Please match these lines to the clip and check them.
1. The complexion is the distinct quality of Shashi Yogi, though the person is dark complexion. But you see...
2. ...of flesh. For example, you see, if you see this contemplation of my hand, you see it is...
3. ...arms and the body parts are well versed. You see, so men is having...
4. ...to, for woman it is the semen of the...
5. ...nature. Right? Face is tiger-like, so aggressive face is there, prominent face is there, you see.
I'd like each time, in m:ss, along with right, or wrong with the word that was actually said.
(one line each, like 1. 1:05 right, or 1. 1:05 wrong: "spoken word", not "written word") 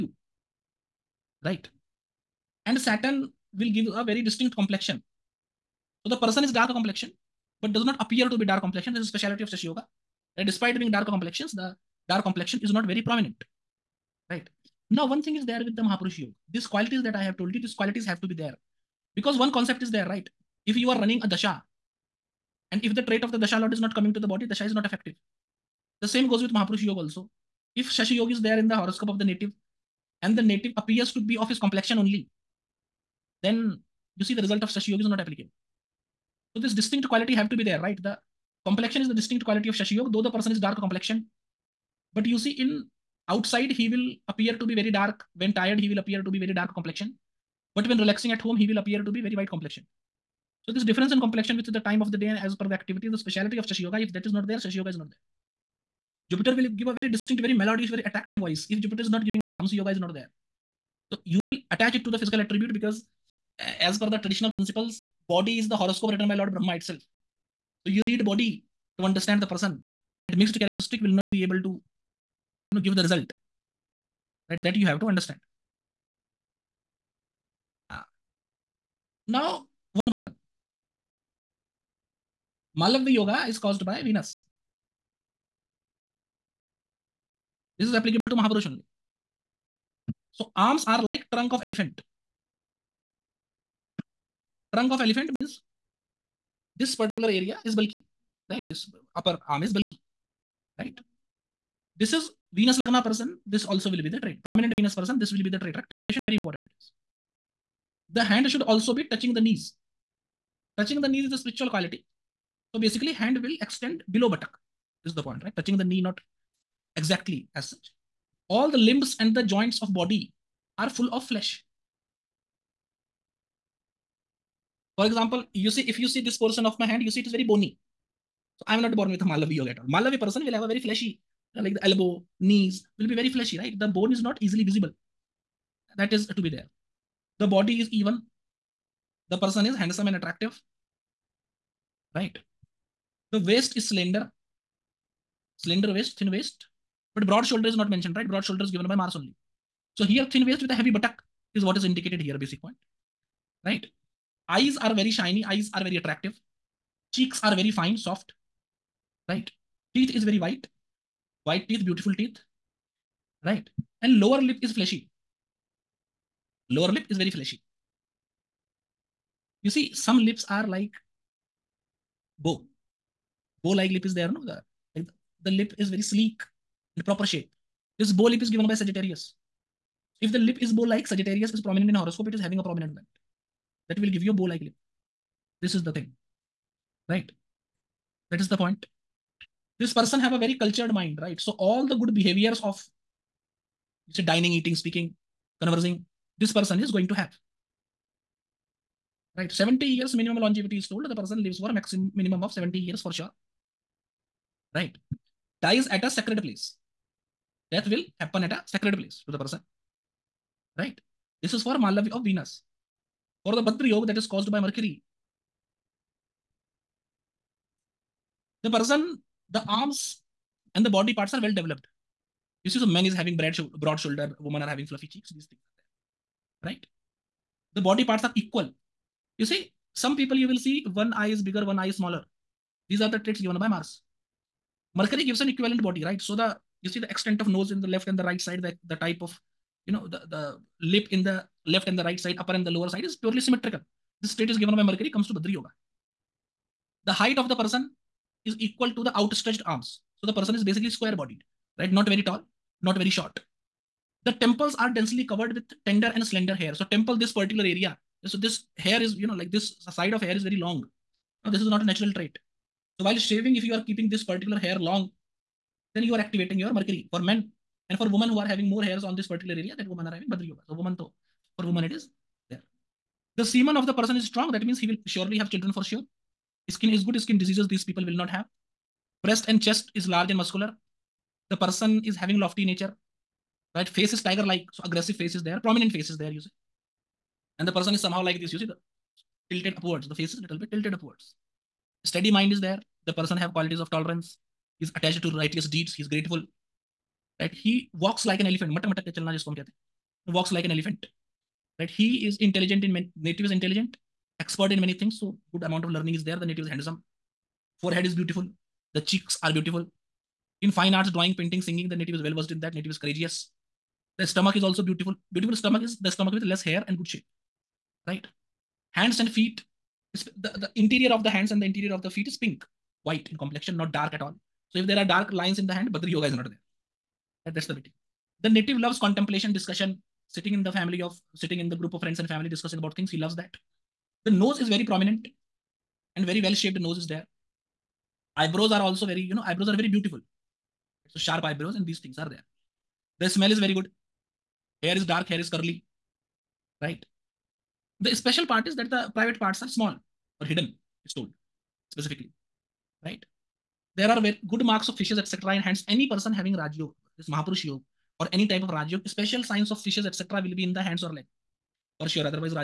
1. 0:38 right
2. 2:01 wrong: "portion", not "contemplation"
3. 3:39 wrong: "developed", not "versed"
4. 4:30 right
5. 4:42 right.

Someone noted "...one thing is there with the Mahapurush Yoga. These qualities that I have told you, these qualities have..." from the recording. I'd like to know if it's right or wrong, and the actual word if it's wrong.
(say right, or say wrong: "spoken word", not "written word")
right.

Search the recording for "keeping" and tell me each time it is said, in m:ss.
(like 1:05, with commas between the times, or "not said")
4:23.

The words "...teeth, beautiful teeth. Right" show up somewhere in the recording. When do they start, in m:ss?
2:41.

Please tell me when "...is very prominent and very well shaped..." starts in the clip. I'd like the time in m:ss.
5:34.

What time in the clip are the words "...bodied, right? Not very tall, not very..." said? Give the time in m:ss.
4:11.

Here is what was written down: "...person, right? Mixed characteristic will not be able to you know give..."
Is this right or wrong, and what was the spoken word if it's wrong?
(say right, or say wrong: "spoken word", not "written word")
right.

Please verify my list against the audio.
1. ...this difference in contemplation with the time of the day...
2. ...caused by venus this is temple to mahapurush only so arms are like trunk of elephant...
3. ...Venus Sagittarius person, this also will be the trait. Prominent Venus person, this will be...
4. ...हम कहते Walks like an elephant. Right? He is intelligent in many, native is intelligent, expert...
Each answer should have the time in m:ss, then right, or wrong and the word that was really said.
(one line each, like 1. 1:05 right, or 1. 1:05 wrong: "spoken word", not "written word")
1. 0:50 wrong: "complexion", not "contemplation"
2. 1:23 wrong: "applicable", not "temple"
3. 1:42 wrong: "Lagna", not "Sagittarius"
4. 4:59 right.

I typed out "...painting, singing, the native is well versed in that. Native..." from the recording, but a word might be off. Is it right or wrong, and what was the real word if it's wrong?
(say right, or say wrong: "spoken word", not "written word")
right.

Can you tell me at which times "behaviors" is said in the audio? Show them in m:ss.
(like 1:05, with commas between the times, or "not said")
3:12.